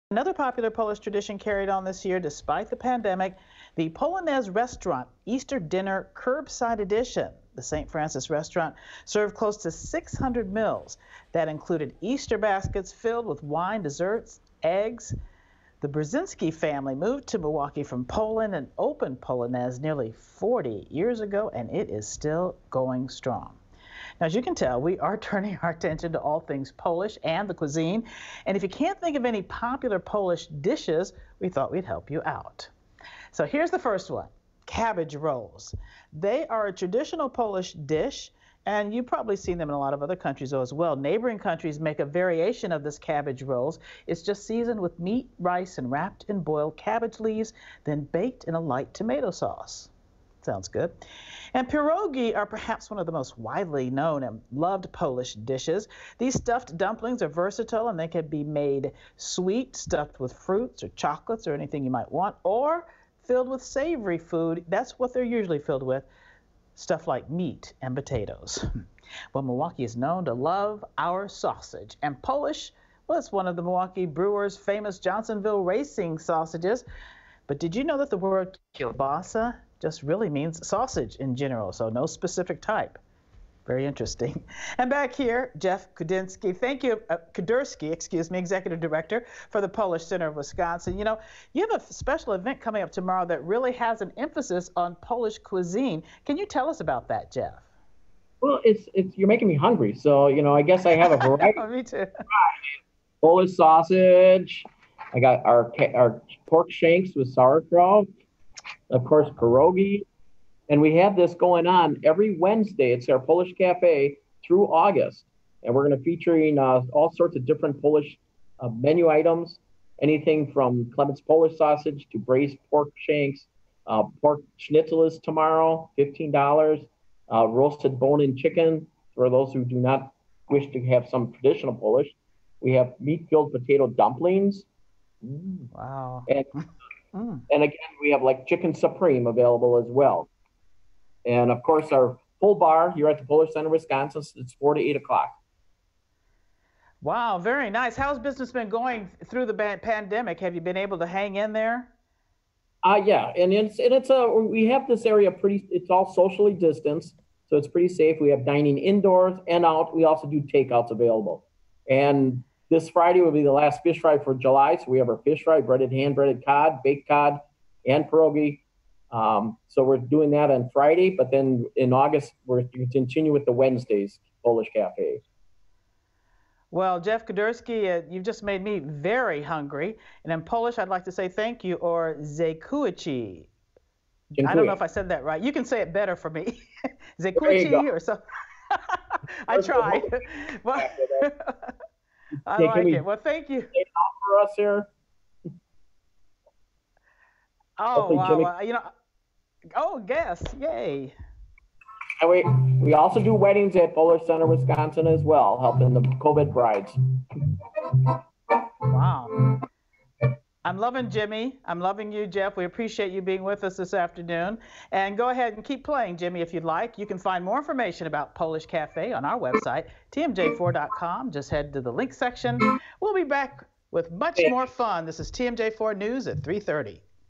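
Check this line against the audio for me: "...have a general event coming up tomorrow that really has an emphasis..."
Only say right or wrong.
wrong.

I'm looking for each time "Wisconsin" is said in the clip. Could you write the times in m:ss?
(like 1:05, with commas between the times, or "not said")
1:30, 2:23, 3:24.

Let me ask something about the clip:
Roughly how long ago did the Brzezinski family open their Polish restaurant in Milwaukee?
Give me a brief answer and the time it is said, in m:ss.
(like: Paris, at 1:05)
nearly 40 years, at 0:19.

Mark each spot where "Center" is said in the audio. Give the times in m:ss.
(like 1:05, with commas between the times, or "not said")
1:30, 2:23, 3:24.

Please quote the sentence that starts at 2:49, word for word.
Um, so we're doing that on Friday, but then in August we're to continue with the Wednesdays Polish Cafe.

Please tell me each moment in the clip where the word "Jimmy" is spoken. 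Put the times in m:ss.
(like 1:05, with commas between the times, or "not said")
3:18, 3:31, 3:36.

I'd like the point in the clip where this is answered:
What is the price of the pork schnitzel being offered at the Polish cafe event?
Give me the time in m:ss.
2:05.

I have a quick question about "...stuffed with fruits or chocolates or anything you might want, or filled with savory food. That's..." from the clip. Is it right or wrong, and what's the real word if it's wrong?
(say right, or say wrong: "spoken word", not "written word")
right.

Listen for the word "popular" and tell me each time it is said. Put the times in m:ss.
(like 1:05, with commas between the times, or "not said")
0:00, 0:29.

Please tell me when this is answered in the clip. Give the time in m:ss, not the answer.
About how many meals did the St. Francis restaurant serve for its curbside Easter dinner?
0:09.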